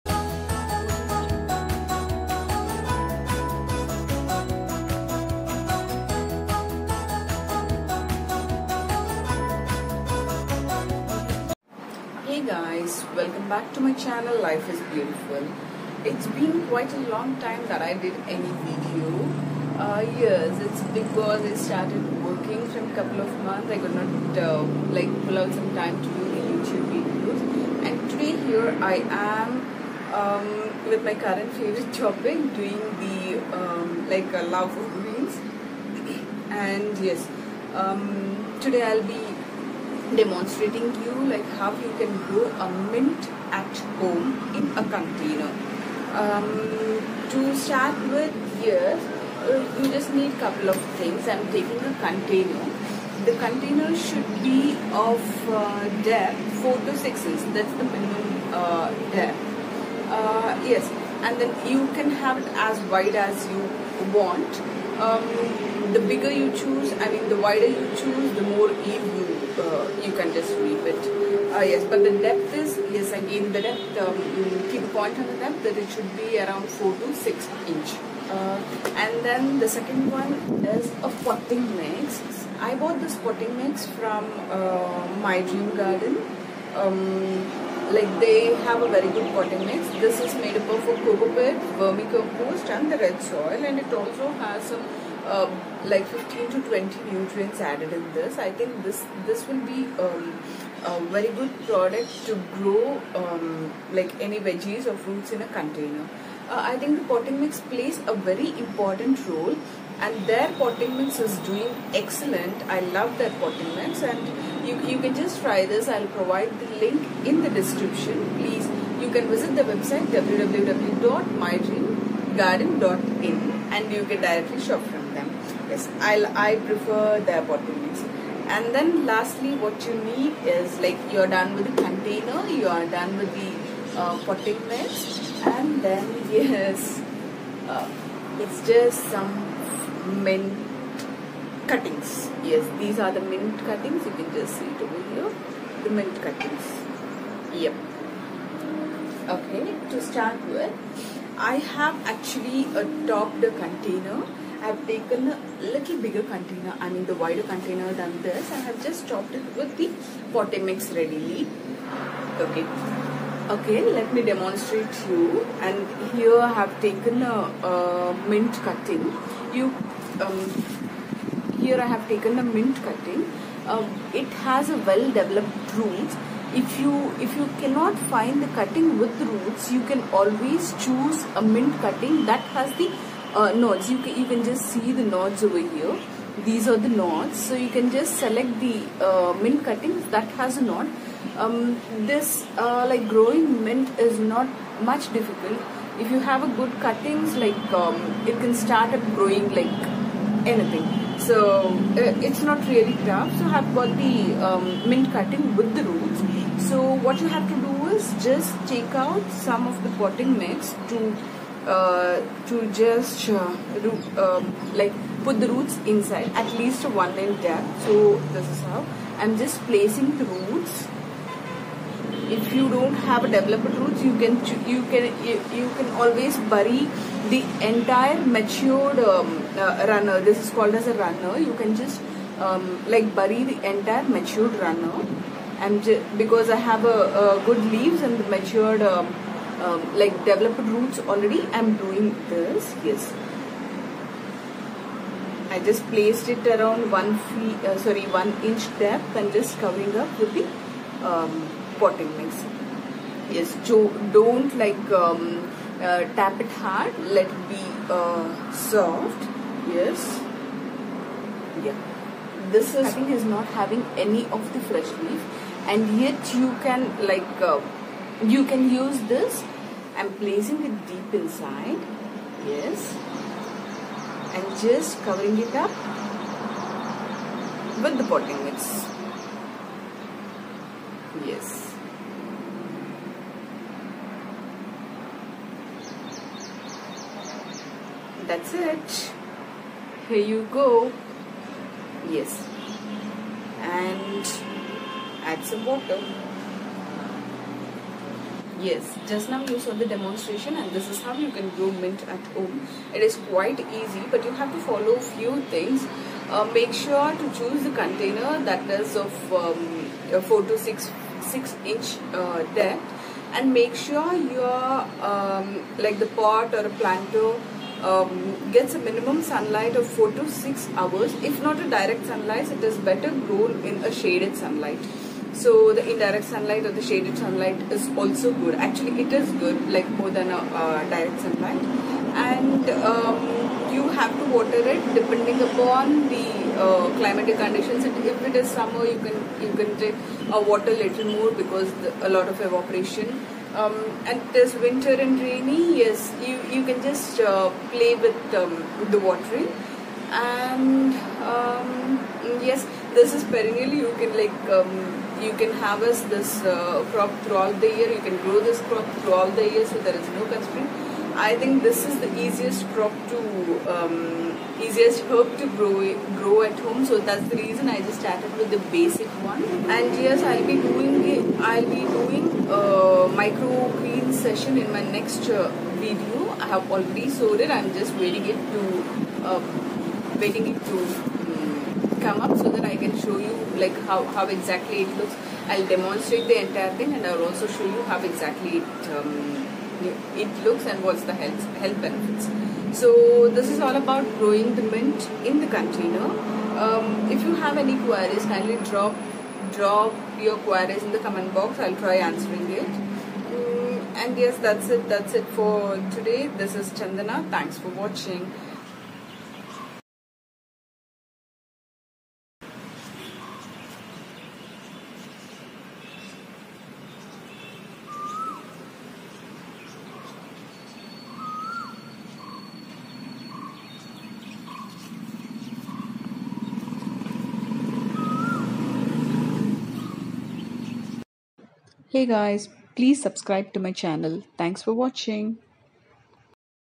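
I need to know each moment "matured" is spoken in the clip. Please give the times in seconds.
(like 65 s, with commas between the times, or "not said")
228 s, 234 s, 238 s.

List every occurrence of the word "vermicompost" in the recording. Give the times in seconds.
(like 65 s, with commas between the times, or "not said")
91 s.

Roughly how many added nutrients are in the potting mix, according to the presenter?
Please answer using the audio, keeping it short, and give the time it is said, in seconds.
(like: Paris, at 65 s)
15 to 20, at 96 s.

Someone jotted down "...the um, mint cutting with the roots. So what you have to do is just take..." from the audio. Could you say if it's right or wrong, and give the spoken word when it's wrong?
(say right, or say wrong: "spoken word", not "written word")
right.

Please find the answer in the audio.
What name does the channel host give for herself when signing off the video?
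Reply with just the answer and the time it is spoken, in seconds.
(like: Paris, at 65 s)
Chandana, at 406 s.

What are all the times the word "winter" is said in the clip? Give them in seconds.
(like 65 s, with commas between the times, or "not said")
344 s.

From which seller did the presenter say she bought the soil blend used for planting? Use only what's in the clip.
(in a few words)
My Dream Garden.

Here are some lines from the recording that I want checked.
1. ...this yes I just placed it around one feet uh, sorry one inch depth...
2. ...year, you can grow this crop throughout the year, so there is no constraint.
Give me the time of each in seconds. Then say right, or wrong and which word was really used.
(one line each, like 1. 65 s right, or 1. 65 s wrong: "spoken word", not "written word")
1. 242 s right
2. 357 s right.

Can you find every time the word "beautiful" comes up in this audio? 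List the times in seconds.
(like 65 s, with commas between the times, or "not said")
14 s.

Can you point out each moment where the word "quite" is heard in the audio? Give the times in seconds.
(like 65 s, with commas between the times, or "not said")
16 s, 303 s.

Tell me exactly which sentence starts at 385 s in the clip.
I'll demonstrate the entire thing and I'll also show you how exactly it, um, it looks and what's the health, health benefits.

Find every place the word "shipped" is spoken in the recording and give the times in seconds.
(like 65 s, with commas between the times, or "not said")
not said.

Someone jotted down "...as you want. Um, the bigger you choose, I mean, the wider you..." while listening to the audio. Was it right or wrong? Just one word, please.
right.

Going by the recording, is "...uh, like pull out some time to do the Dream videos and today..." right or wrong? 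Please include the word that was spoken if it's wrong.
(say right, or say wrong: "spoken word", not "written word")
wrong: "YouTube", not "Dream".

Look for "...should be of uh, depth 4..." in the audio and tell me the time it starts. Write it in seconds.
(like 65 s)
53 s.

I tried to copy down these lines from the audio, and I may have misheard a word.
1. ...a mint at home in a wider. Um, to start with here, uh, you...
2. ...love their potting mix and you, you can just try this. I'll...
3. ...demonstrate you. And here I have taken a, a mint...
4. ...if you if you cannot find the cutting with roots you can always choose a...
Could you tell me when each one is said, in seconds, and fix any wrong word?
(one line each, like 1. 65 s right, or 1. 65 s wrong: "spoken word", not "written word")
1. 42 s wrong: "container", not "wider"
2. 112 s right
3. 164 s right
4. 176 s right.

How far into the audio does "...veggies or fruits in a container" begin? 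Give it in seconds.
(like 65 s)
104 s.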